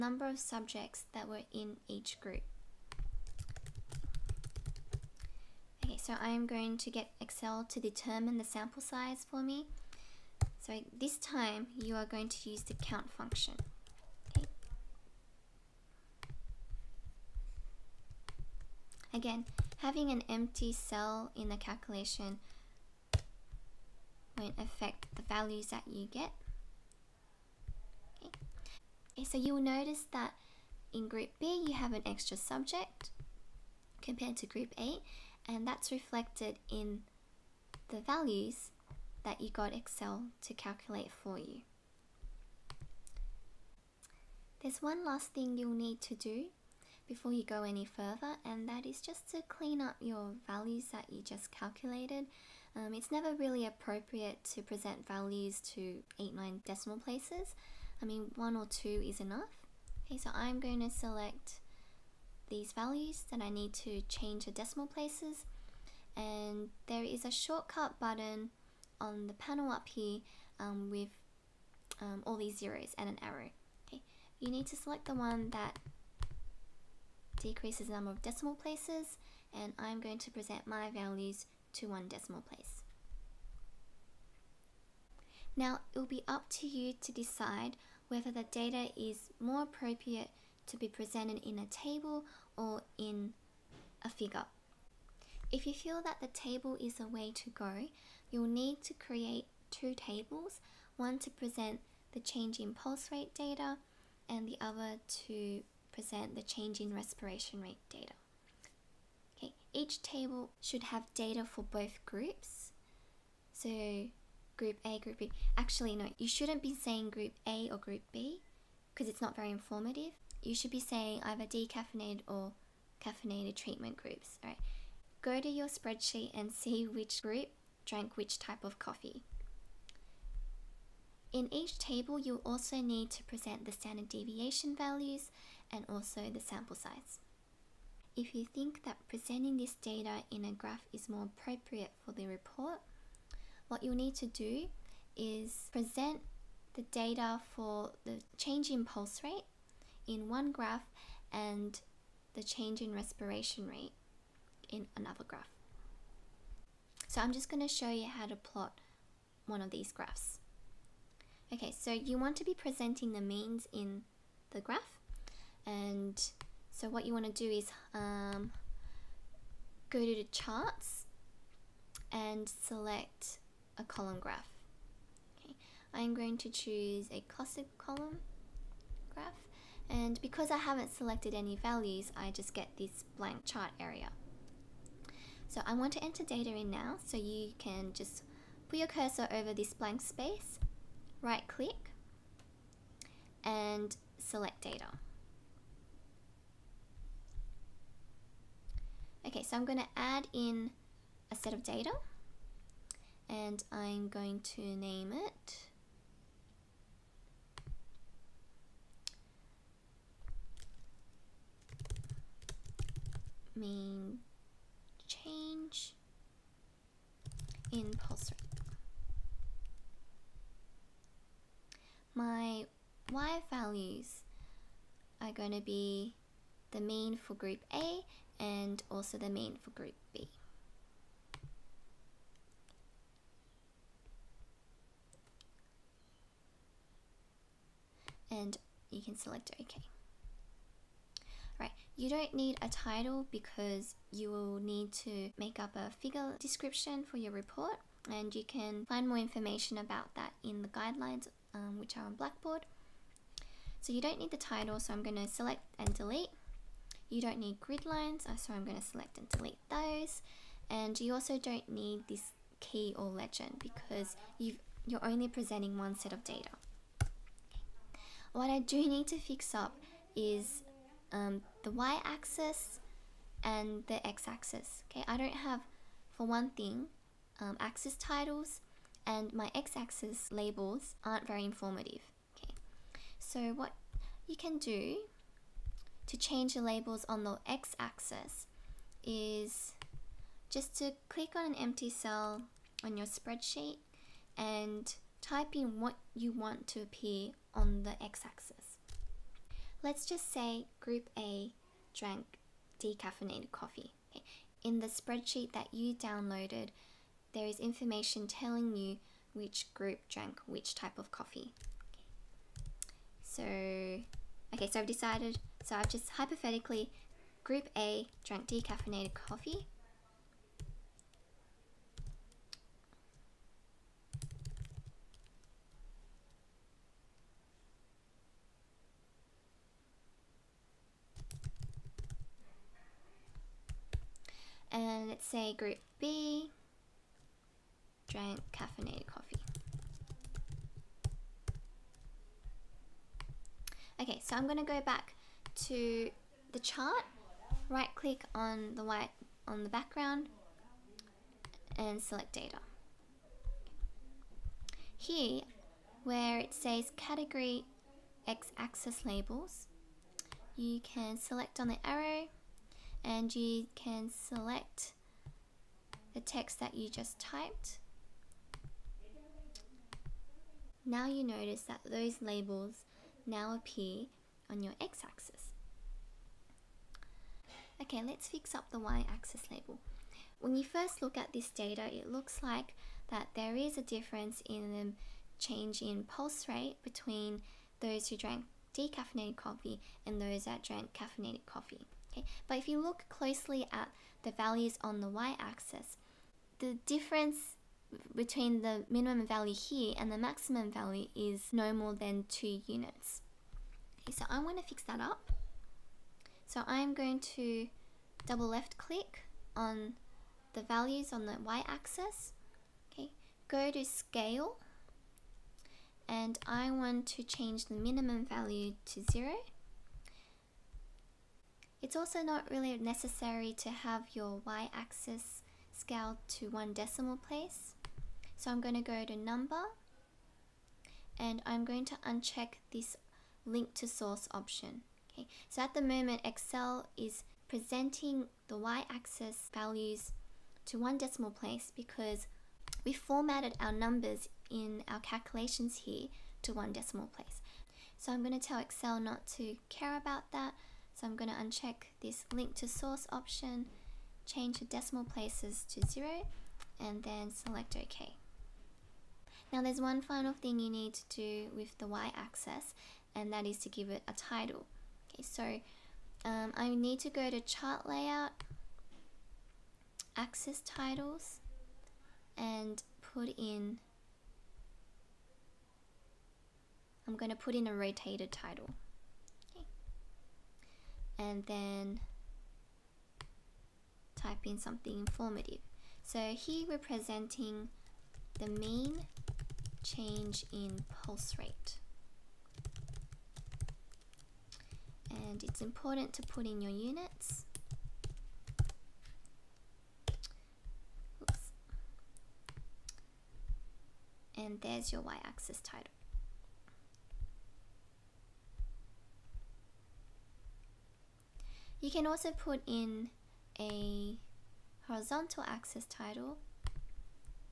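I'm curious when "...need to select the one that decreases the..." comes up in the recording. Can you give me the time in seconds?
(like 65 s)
74 s.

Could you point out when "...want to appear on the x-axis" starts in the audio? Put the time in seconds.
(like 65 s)
296 s.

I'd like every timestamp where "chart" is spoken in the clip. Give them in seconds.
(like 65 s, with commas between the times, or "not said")
170 s, 183 s, 346 s, 467 s.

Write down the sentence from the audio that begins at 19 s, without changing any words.
Again, having an empty cell in the calculation won't affect the values that you get.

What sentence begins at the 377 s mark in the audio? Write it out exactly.
Okay, let's fix up the y-axis label.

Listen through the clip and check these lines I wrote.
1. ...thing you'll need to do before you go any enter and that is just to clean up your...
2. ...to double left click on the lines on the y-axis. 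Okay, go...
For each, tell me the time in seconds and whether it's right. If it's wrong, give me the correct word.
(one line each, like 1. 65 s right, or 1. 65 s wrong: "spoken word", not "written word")
1. 45 s wrong: "further", not "enter"
2. 407 s wrong: "values", not "lines".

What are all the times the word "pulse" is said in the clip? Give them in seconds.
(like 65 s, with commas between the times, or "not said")
102 s, 148 s, 217 s, 386 s, 491 s.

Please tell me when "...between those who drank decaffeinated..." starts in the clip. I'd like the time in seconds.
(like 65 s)
386 s.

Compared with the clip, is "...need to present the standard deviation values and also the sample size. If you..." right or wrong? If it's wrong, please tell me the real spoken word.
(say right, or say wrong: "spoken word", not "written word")
right.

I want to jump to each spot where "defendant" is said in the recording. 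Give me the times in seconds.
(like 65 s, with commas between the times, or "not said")
not said.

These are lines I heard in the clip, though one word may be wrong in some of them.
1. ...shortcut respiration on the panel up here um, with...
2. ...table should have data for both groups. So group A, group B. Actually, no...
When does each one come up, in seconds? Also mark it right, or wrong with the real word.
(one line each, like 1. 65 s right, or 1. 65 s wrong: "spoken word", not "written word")
1. 67 s wrong: "button", not "respiration"
2. 110 s right.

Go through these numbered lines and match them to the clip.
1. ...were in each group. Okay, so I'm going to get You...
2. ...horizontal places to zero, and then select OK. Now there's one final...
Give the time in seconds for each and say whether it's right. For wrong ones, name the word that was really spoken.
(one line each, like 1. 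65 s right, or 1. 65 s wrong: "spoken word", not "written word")
1. 1 s wrong: "Excel", not "You"
2. 454 s wrong: "decimal", not "horizontal".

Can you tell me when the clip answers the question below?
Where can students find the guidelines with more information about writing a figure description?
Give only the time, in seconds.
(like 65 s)
252 s.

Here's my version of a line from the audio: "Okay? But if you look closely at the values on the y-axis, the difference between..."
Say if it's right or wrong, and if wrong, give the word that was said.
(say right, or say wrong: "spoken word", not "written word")
right.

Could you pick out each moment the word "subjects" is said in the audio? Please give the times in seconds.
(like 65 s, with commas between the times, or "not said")
0 s, 32 s.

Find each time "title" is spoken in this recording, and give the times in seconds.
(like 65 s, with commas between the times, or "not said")
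242 s, 254 s, 277 s, 464 s, 470 s, 478 s, 505 s, 515 s.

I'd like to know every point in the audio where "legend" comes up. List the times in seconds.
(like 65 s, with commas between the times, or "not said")
263 s.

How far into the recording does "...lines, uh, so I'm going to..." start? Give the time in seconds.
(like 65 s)
257 s.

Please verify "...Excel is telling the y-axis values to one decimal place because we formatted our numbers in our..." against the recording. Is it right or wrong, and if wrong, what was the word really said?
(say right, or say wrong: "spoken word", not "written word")
wrong: "presenting", not "telling".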